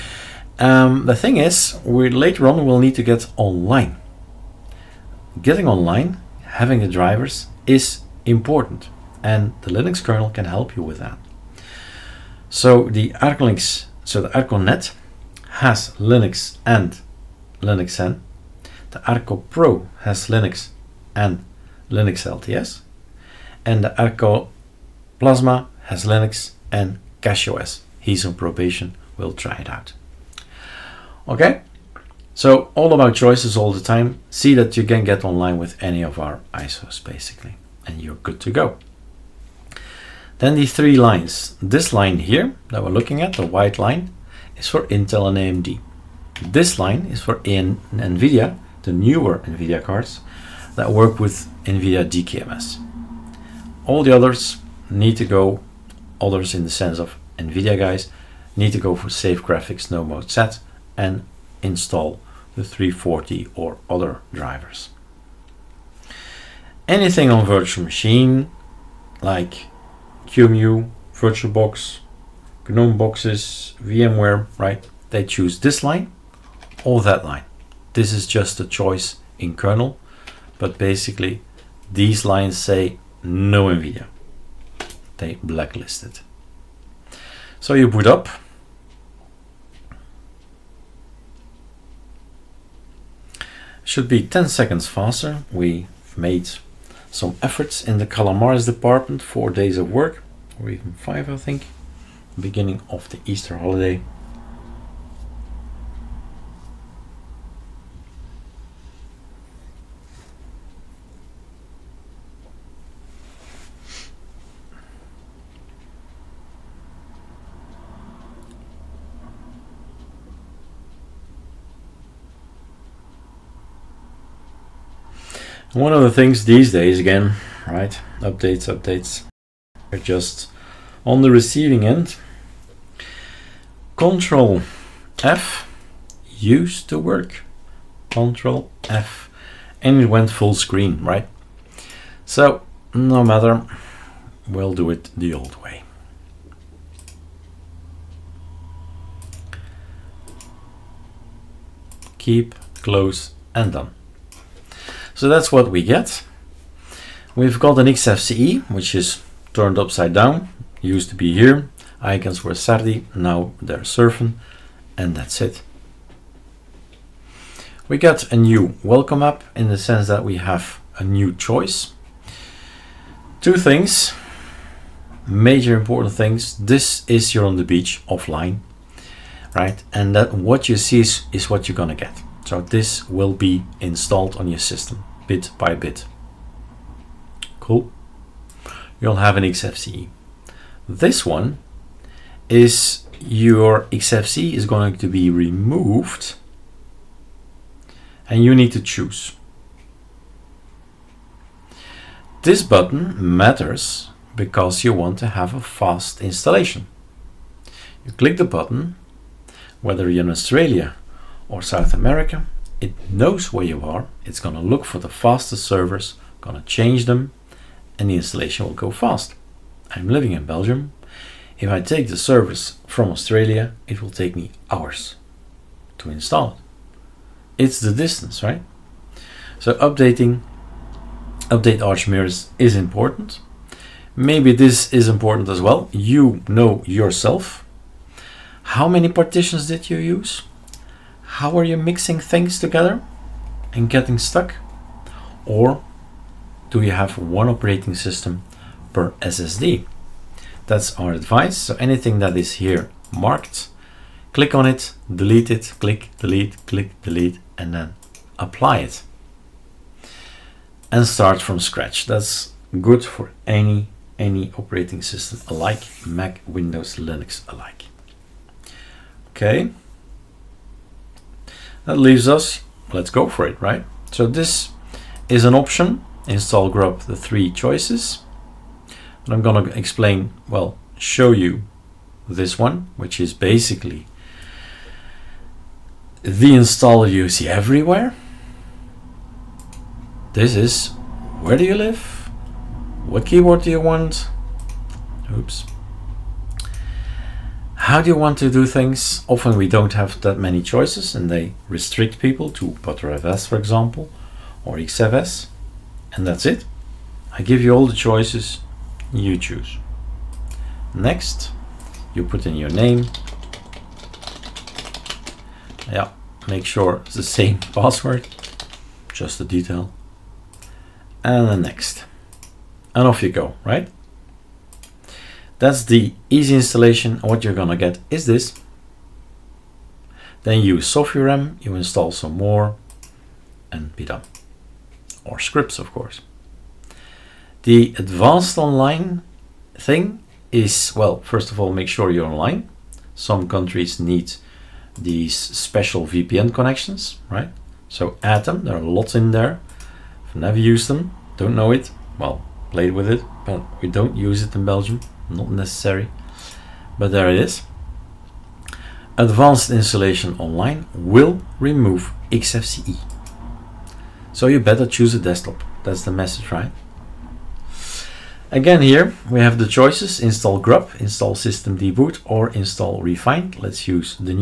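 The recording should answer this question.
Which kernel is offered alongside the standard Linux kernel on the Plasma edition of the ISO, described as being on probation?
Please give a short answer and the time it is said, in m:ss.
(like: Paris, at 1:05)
CachyOS, at 0:27.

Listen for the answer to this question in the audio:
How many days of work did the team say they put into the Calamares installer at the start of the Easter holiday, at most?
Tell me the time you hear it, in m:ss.
1:40.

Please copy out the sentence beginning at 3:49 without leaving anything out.
So updating, update Arch Mirrors is important.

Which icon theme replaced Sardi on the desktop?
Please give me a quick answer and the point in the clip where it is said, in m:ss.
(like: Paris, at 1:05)
Surfn, at 2:43.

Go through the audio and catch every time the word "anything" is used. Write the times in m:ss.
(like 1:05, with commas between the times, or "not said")
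1:06, 4:11.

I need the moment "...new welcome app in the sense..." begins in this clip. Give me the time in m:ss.
2:48.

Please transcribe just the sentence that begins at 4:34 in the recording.
So this is an option, install grub, the three choices.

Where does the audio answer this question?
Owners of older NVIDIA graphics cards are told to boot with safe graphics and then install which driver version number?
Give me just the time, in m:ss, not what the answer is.
1:02.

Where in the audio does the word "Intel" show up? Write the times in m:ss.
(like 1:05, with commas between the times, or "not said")
0:44.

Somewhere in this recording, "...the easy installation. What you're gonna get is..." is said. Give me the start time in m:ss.
5:25.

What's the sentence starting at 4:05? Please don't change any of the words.
Or do you have one operating system per SSD?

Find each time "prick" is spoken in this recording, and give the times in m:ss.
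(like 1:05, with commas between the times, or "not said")
not said.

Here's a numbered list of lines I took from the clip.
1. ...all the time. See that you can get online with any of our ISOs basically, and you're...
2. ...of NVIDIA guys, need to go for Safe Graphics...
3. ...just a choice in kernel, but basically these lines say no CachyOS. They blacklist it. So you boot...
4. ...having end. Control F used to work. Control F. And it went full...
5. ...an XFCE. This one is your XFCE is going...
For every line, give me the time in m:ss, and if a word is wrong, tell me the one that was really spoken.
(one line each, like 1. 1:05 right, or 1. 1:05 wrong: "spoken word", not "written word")
1. 0:33 right
2. 0:56 right
3. 1:18 wrong: "NVIDIA", not "CachyOS"
4. 2:11 wrong: "receiving", not "having"
5. 3:09 right.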